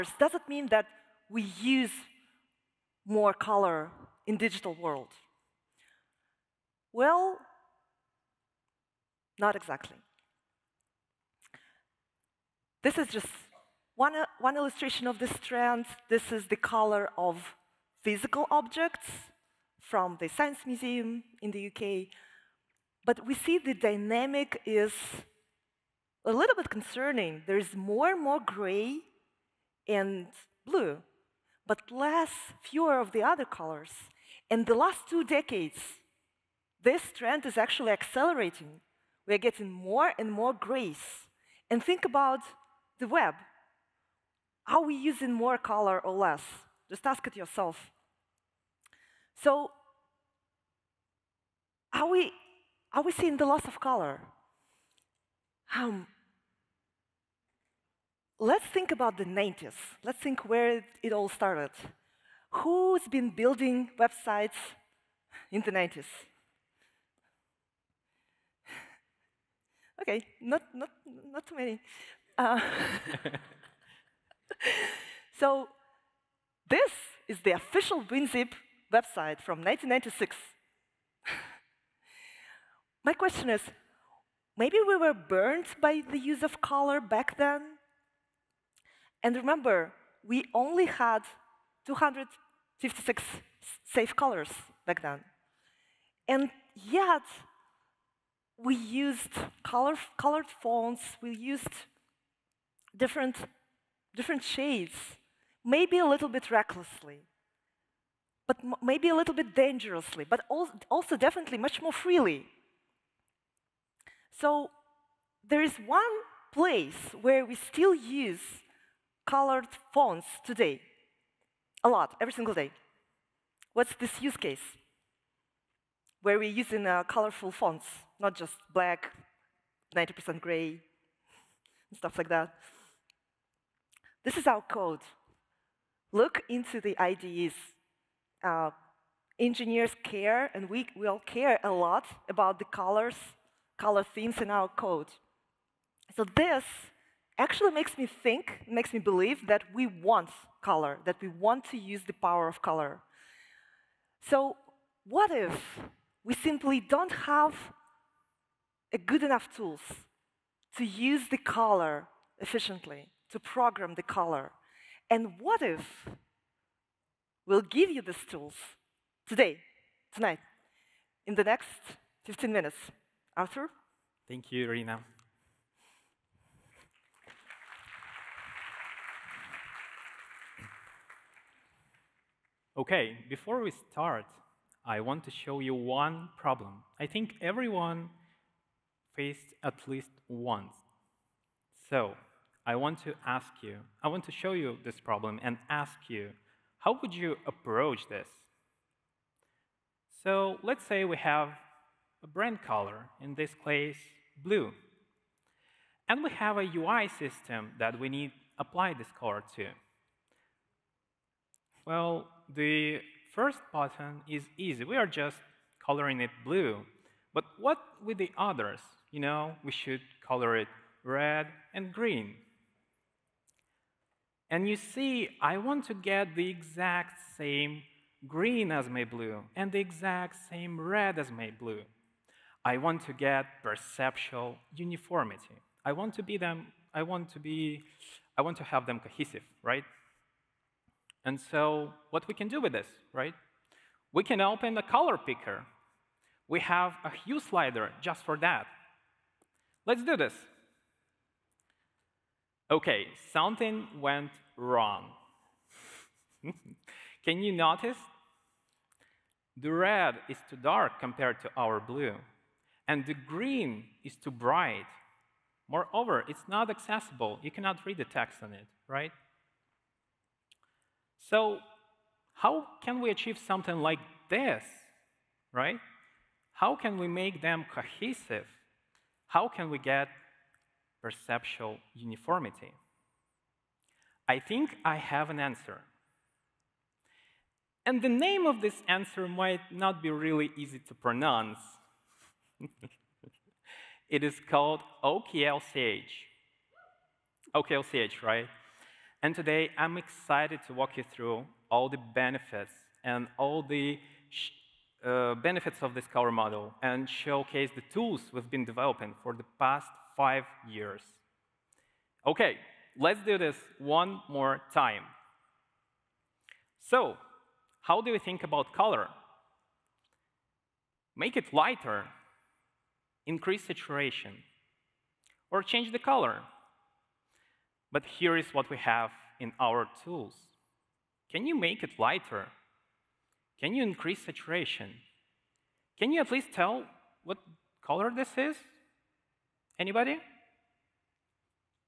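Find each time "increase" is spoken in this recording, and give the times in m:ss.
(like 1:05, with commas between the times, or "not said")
5:23, 5:33.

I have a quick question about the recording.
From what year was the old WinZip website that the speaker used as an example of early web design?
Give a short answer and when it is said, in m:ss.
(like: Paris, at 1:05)
1996, at 1:19.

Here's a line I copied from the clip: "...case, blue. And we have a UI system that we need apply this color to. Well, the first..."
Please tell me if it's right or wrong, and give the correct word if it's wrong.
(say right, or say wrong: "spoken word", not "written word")
right.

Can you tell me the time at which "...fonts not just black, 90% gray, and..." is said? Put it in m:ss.
2:07.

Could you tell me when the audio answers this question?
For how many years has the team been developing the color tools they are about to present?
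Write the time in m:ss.
5:10.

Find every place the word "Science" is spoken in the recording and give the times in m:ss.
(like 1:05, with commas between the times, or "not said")
0:20.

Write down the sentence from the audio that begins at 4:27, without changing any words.
You cannot read the text on it, right?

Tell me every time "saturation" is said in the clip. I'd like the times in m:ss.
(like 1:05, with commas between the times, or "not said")
5:23, 5:34.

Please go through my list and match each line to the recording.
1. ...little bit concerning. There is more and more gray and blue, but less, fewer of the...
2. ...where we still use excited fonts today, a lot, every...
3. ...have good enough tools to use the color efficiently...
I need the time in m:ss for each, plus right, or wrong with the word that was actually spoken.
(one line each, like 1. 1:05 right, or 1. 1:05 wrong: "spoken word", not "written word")
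1. 0:26 right
2. 1:57 wrong: "colored", not "excited"
3. 2:37 right.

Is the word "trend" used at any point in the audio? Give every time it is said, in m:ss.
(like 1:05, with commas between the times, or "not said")
0:15, 0:37.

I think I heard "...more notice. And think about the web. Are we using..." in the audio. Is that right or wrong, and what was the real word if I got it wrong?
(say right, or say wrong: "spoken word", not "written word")
wrong: "grace", not "notice".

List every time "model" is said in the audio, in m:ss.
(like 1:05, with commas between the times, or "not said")
5:06.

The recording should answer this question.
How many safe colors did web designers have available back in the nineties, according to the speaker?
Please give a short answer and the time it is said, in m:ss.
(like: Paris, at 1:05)
256, at 1:31.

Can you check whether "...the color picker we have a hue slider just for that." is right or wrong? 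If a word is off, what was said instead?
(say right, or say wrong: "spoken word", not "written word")
right.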